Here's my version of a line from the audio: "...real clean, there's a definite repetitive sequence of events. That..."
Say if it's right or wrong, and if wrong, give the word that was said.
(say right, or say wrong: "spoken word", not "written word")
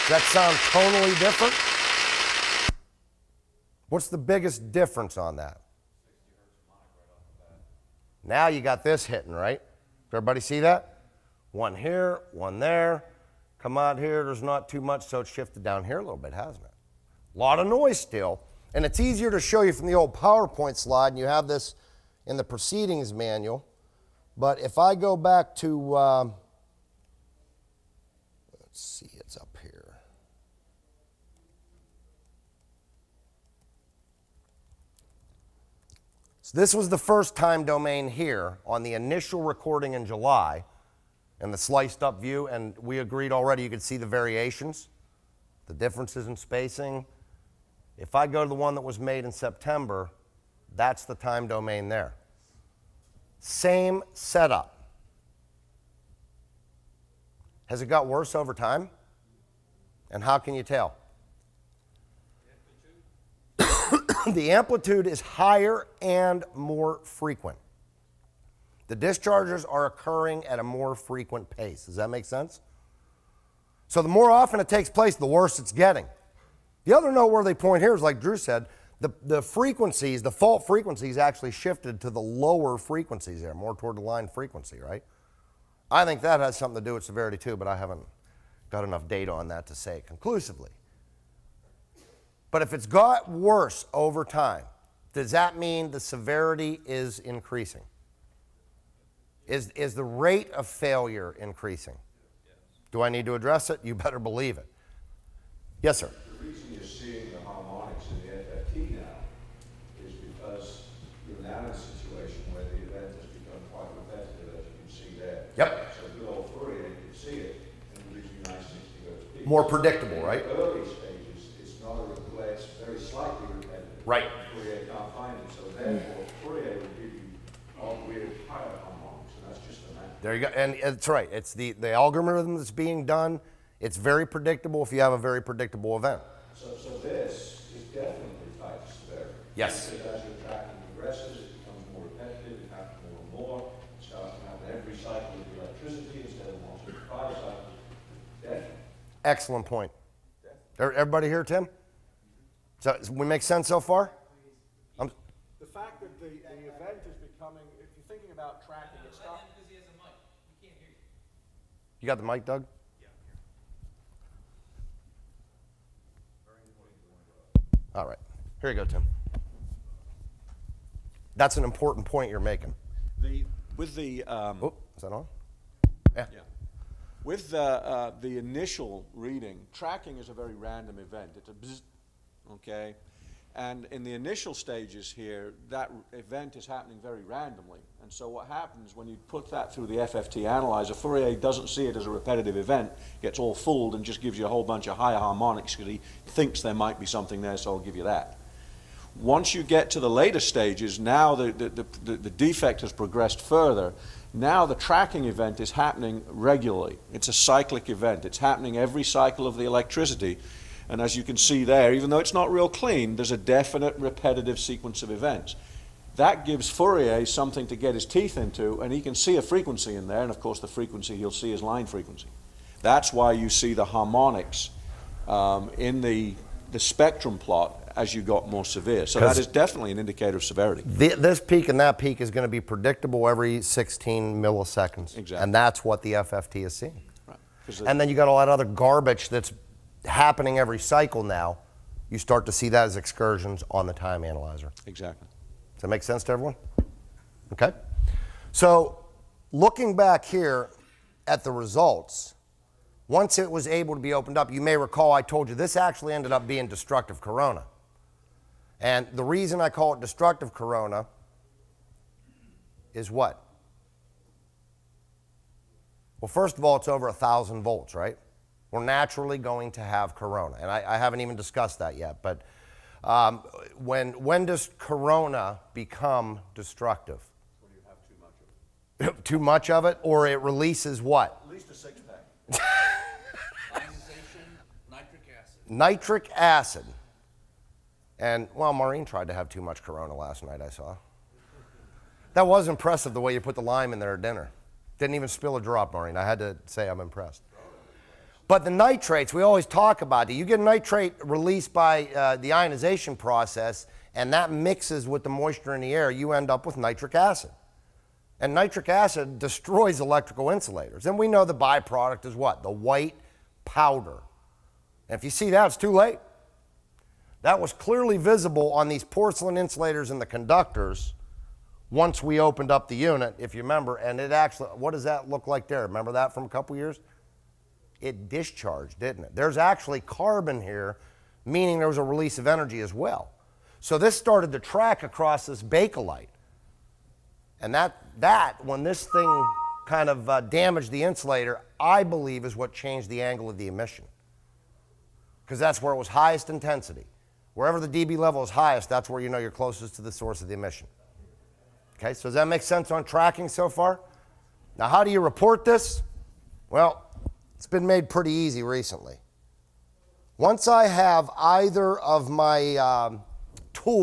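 right.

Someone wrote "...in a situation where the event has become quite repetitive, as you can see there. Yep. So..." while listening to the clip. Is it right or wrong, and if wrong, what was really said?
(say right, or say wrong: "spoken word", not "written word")
right.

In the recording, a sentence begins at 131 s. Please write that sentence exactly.
It's the, the algorithm that's being done.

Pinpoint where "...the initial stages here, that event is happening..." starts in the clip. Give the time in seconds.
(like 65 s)
184 s.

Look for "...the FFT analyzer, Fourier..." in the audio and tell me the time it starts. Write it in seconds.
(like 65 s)
189 s.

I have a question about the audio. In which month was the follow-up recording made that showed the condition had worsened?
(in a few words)
September.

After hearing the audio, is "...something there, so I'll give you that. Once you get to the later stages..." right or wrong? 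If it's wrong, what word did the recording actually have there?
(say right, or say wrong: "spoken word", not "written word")
right.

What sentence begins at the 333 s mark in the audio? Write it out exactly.
So this started to track across this bakelite.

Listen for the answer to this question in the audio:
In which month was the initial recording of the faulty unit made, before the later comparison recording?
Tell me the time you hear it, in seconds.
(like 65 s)
40 s.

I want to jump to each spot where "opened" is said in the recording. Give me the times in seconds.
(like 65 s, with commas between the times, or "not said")
254 s, 322 s.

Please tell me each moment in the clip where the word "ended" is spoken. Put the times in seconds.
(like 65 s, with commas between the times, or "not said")
256 s.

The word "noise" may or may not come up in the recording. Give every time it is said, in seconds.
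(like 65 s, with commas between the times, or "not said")
17 s.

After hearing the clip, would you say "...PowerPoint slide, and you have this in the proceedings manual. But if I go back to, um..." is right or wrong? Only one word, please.
right.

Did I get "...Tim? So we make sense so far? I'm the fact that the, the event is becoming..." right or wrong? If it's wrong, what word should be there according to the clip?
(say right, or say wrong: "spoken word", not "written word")
right.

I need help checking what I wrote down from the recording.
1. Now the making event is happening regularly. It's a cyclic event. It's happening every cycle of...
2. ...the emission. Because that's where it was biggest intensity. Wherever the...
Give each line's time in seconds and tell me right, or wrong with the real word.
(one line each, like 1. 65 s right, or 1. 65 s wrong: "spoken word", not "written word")
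1. 204 s wrong: "tracking", not "making"
2. 343 s wrong: "highest", not "biggest".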